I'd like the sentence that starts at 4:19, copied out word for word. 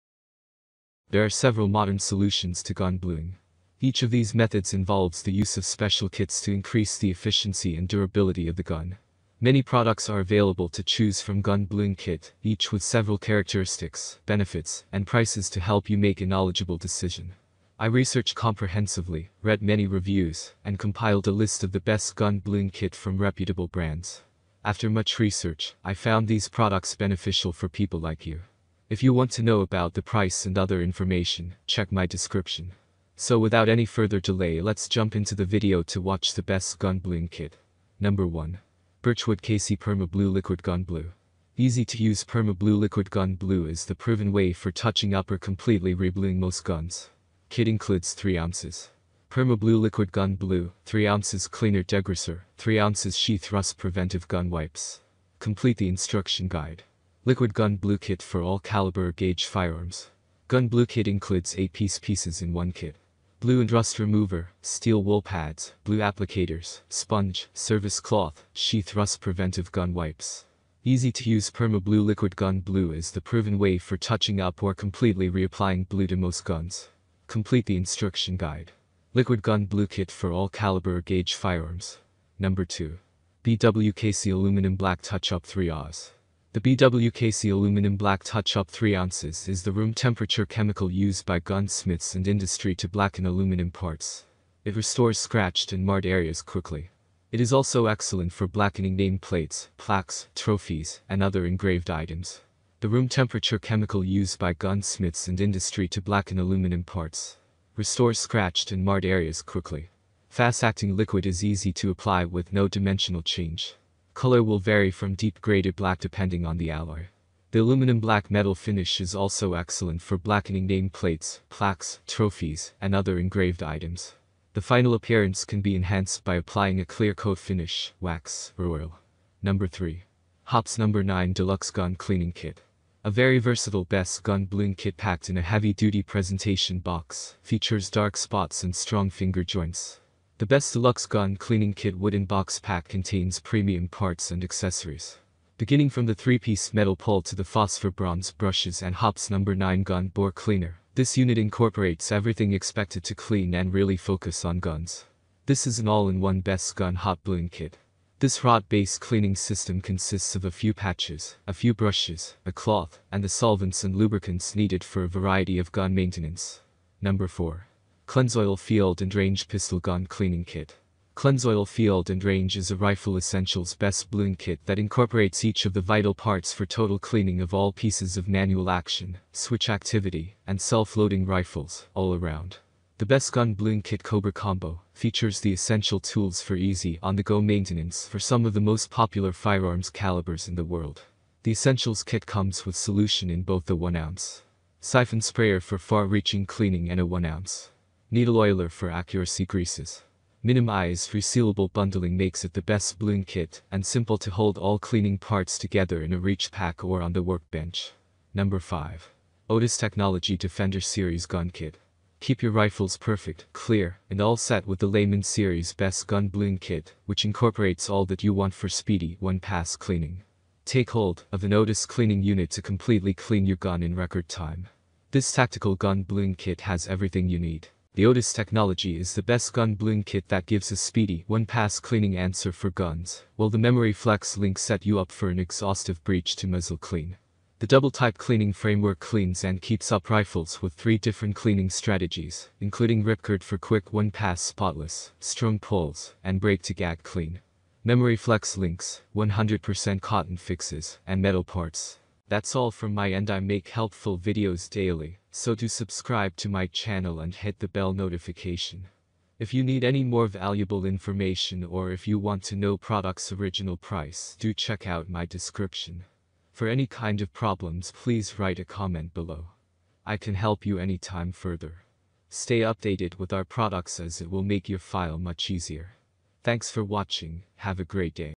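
If you need any more valuable information or if you want to know product's original price, do check out my description.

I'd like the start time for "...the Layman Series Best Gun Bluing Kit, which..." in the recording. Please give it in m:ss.
3:34.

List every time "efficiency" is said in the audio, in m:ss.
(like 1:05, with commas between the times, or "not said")
0:07.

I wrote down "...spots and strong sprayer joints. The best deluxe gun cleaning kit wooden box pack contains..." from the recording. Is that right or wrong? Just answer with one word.
wrong.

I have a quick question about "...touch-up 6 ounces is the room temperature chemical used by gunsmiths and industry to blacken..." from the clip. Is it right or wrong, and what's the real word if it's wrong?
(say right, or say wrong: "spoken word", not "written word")
wrong: "3", not "6".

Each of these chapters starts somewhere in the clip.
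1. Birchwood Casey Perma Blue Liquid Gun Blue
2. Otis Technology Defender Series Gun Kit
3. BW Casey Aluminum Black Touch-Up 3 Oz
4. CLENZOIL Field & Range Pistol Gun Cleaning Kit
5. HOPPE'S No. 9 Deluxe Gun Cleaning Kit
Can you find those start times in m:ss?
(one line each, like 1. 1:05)
1. 0:37
2. 3:28
3. 1:22
4. 2:46
5. 2:09.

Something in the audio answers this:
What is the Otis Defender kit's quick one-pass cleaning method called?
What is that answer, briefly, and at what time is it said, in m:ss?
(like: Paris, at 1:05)
Ripcord, at 4:03.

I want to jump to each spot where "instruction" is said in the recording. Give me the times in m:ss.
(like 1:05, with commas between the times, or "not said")
0:55, 1:17.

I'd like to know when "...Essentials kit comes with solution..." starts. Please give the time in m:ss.
3:11.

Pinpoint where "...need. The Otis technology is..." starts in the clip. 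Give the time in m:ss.
3:47.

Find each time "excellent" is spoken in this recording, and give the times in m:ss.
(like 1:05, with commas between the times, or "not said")
1:37, 1:59.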